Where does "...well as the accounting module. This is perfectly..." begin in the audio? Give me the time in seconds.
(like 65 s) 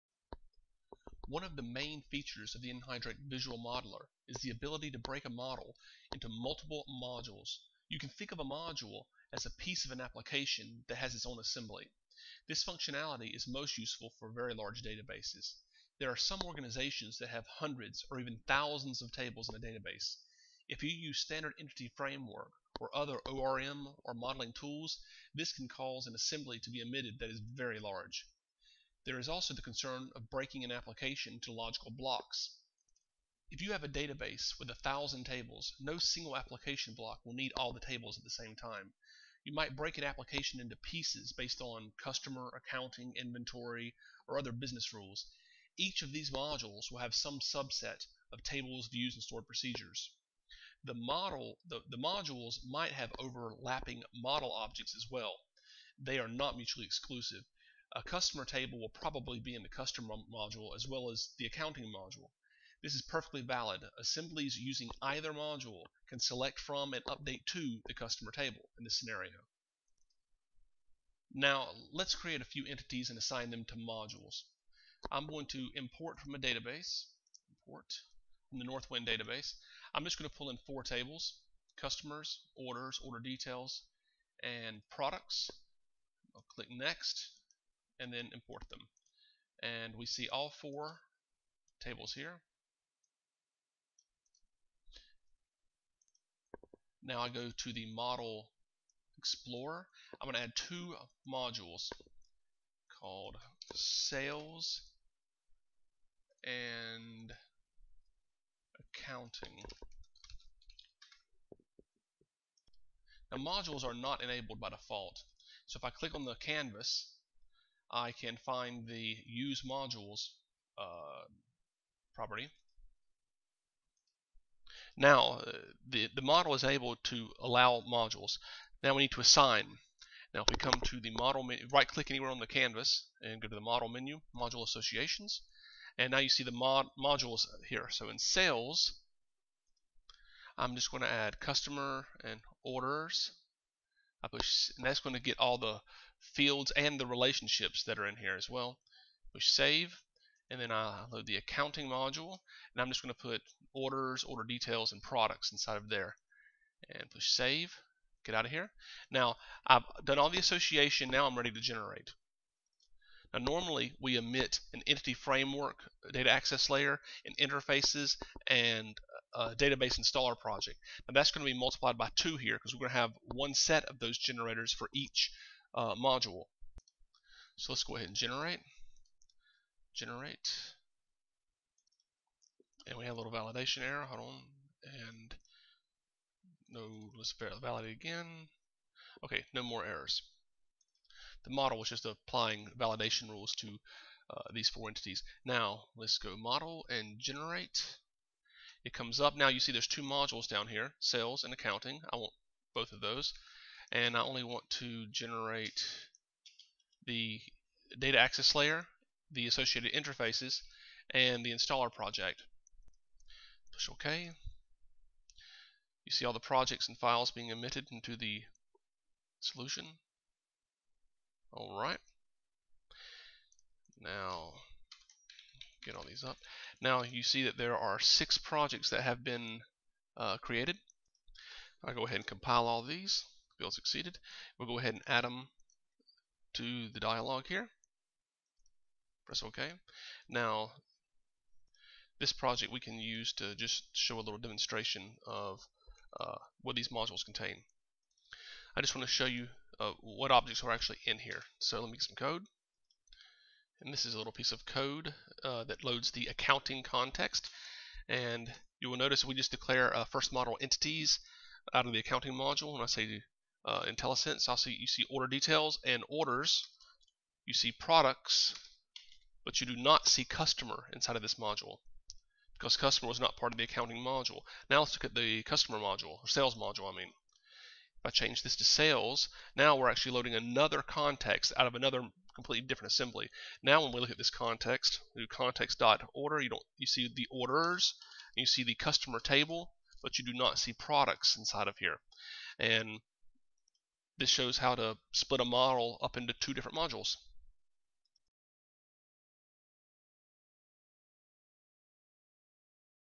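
60 s.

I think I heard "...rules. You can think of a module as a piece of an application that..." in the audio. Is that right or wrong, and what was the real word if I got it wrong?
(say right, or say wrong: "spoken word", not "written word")
wrong: "modules", not "rules".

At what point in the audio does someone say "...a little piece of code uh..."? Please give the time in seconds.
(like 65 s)
254 s.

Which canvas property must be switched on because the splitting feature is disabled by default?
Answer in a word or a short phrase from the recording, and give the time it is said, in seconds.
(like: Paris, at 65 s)
use modules, at 119 s.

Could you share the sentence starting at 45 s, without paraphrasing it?
Each of these modules will have some subset of tables, views, and stored procedures.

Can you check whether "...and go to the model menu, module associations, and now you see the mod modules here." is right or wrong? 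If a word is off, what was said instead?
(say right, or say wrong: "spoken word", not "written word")
right.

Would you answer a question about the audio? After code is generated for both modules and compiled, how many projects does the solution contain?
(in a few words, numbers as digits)
6.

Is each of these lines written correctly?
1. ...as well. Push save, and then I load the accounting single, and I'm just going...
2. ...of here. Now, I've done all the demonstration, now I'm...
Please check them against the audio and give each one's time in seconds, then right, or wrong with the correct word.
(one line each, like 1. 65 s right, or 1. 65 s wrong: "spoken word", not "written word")
1. 148 s wrong: "module", not "single"
2. 158 s wrong: "association", not "demonstration".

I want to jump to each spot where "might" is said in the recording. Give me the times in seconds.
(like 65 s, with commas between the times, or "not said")
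39 s, 52 s.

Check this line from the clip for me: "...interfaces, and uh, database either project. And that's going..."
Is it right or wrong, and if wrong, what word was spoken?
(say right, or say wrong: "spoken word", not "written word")
wrong: "installer", not "either".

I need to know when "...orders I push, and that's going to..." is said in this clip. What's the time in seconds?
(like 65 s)
142 s.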